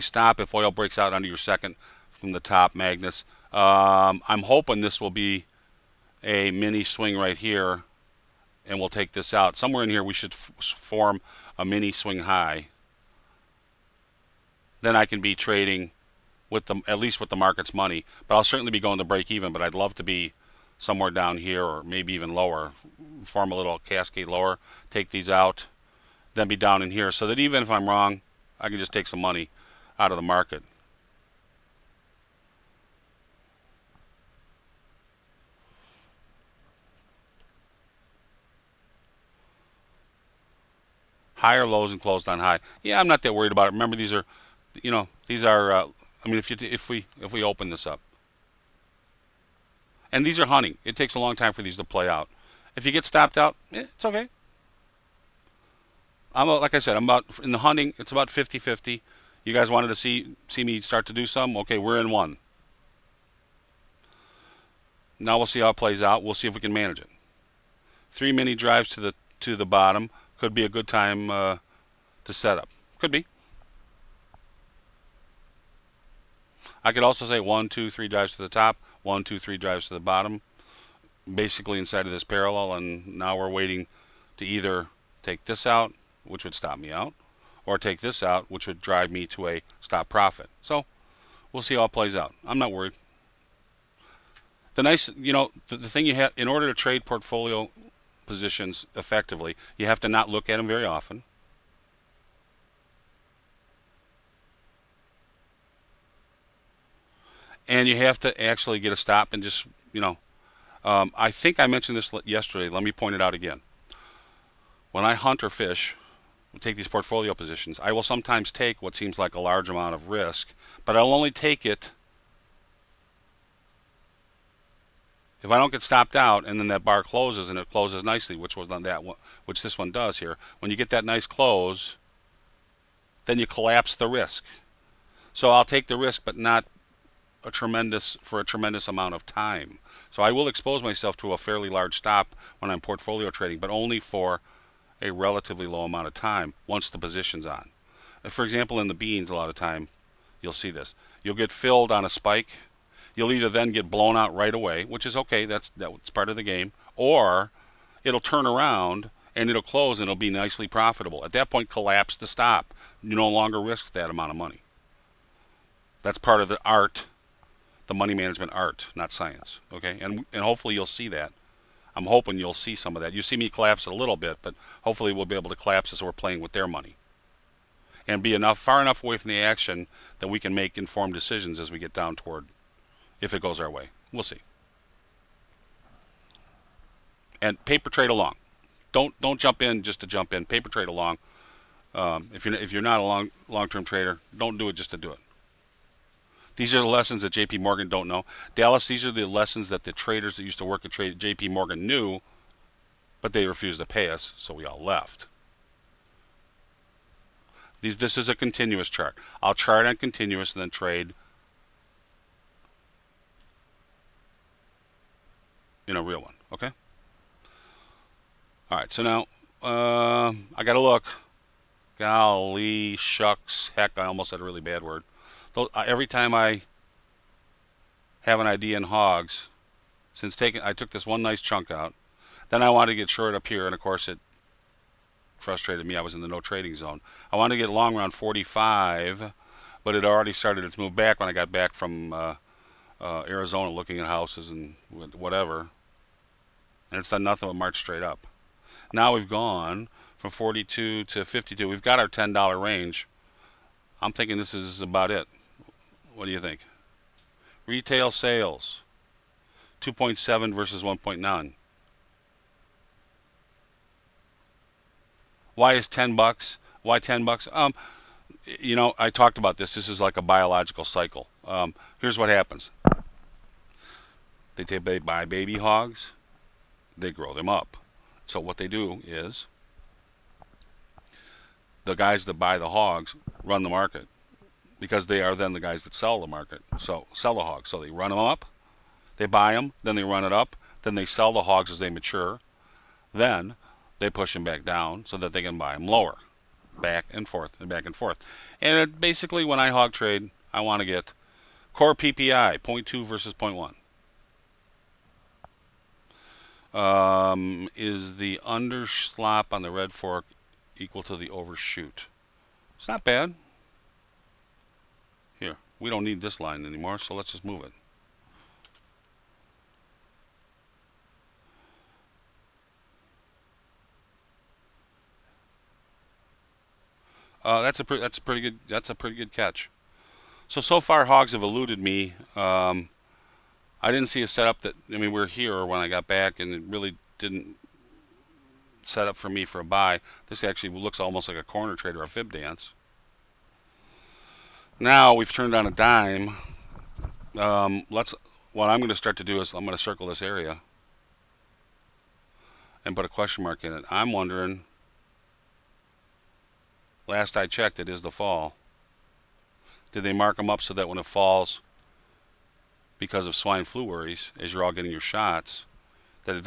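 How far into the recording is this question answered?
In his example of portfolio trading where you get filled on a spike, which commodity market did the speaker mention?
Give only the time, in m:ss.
2:28.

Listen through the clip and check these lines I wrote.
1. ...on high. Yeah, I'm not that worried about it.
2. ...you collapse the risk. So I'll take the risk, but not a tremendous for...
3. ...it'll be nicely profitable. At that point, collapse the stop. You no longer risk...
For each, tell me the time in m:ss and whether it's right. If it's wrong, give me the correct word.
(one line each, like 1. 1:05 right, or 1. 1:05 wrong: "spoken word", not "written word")
1. 0:42 right
2. 2:13 right
3. 2:40 right.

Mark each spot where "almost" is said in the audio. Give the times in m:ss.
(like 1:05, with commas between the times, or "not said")
3:44, 5:40.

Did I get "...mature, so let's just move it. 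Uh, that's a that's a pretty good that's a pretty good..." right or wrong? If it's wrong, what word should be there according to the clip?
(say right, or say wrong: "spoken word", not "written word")
wrong: "anymore", not "mature".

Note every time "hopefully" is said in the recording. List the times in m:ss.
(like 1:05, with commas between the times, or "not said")
2:50, 2:54.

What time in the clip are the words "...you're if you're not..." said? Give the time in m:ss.
3:12.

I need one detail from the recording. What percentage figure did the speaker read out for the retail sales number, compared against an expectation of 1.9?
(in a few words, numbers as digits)
2.7.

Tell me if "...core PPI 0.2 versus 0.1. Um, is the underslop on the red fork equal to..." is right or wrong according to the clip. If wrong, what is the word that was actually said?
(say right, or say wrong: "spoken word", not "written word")
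right.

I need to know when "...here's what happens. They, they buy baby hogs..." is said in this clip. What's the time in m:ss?
4:31.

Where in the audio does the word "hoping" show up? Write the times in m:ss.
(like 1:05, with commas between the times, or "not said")
0:04, 2:52.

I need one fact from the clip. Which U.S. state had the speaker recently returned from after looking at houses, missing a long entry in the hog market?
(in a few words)
Arizona.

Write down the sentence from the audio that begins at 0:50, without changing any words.
It takes a long time for these to play out.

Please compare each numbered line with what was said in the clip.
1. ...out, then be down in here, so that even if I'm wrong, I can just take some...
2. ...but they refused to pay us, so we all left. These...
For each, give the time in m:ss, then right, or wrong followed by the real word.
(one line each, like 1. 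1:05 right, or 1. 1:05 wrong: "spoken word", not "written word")
1. 0:25 right
2. 3:23 right.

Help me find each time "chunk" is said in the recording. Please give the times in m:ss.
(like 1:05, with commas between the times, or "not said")
3:51.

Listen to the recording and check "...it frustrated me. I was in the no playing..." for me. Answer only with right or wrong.
wrong.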